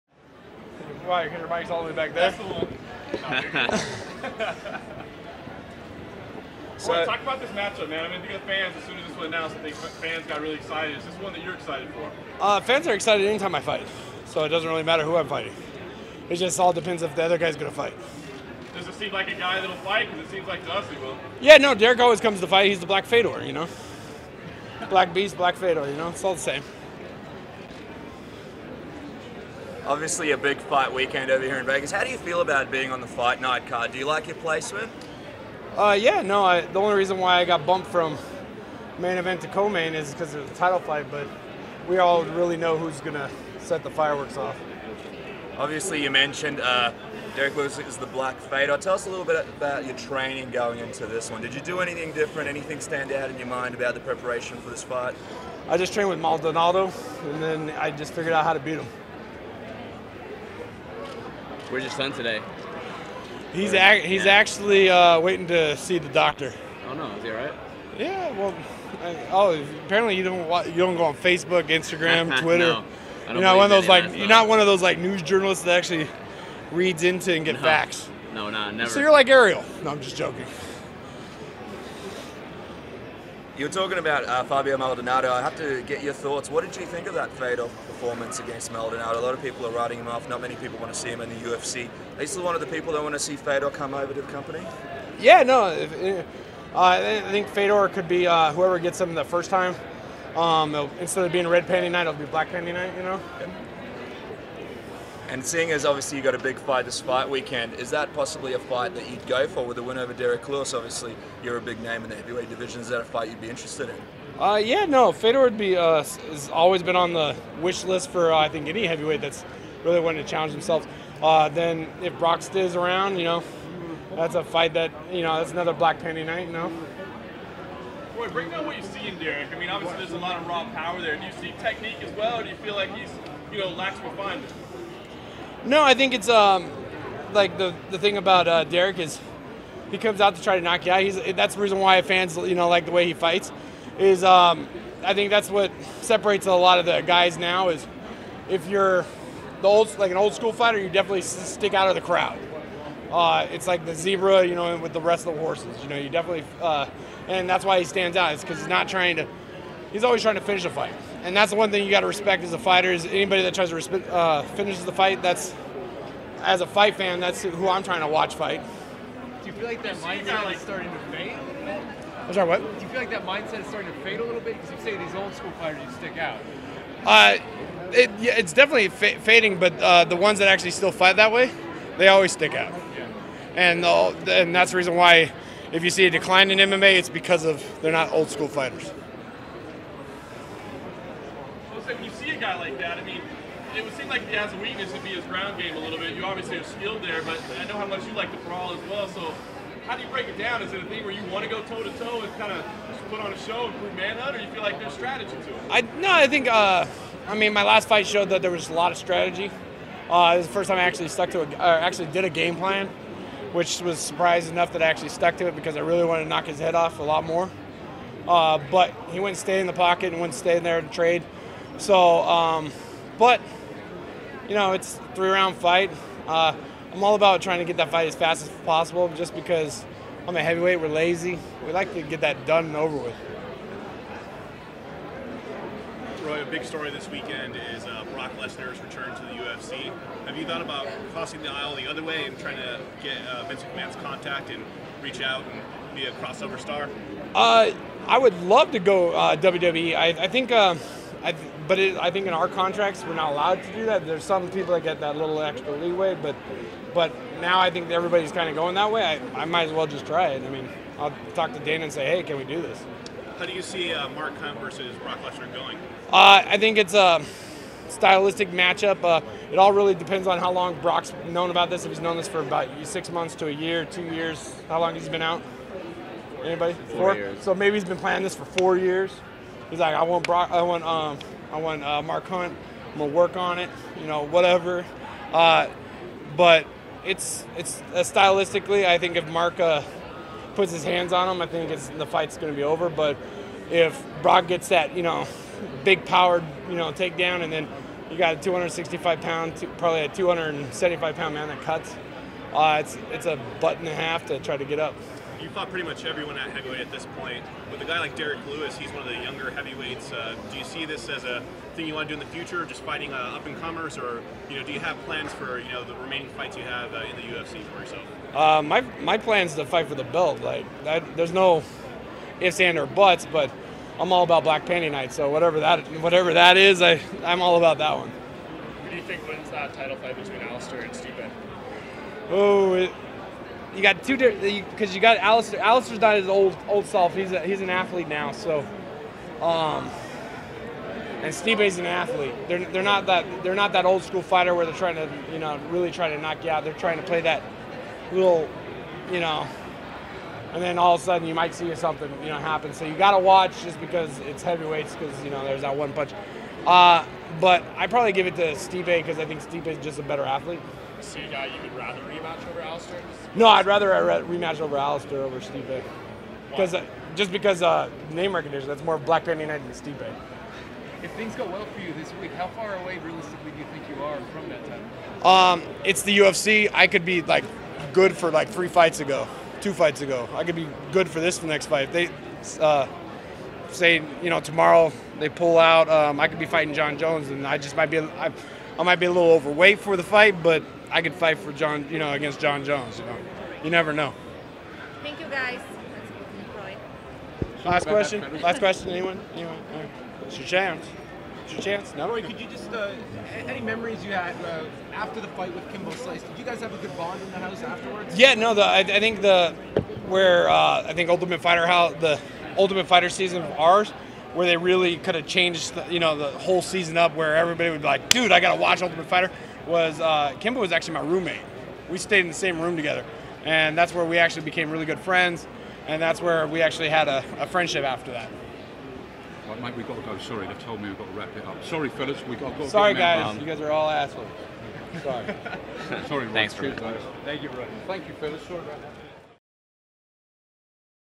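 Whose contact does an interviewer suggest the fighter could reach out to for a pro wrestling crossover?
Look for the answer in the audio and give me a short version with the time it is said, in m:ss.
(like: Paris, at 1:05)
Vince McMahon, at 4:03.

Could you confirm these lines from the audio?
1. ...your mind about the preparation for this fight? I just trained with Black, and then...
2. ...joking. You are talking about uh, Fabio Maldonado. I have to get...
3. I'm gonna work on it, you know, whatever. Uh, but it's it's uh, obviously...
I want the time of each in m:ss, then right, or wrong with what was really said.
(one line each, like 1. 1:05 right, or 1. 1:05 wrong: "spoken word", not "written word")
1. 0:53 wrong: "Maldonado", not "Black"
2. 1:20 right
3. 4:42 wrong: "stylistically", not "obviously".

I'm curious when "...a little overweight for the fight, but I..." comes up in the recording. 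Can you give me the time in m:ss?
6:29.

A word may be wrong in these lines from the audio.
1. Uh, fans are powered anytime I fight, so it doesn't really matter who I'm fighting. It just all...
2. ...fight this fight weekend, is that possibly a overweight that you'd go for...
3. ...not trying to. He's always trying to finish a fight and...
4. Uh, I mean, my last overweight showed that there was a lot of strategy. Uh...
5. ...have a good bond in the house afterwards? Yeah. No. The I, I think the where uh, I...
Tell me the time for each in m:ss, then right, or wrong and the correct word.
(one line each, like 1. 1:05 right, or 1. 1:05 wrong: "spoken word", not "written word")
1. 0:12 wrong: "excited", not "powered"
2. 1:46 wrong: "fight", not "overweight"
3. 2:38 right
4. 3:26 wrong: "fight", not "overweight"
5. 6:46 right.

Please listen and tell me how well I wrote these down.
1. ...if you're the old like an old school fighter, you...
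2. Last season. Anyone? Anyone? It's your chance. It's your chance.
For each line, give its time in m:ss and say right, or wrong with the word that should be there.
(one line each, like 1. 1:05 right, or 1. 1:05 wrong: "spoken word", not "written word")
1. 2:28 right
2. 6:38 wrong: "question", not "season".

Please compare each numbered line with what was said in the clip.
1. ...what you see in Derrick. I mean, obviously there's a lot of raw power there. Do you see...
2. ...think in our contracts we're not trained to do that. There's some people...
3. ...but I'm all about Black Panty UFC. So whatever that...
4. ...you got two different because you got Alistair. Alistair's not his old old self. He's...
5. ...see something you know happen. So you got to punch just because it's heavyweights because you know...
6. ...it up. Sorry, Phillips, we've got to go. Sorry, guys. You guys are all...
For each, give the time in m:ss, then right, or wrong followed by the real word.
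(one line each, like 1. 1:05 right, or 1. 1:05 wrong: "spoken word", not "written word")
1. 2:08 right
2. 4:12 wrong: "allowed", not "trained"
3. 5:23 wrong: "Night", not "UFC"
4. 5:33 right
5. 5:51 wrong: "watch", not "punch"
6. 7:11 right.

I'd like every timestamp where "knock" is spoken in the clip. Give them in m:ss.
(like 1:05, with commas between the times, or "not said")
2:20, 3:36, 5:46.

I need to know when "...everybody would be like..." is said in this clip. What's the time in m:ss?
6:57.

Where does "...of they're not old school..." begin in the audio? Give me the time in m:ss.
3:07.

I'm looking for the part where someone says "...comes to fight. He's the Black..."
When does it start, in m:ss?
0:22.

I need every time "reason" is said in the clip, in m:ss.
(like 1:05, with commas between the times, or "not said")
0:36, 2:21, 3:04.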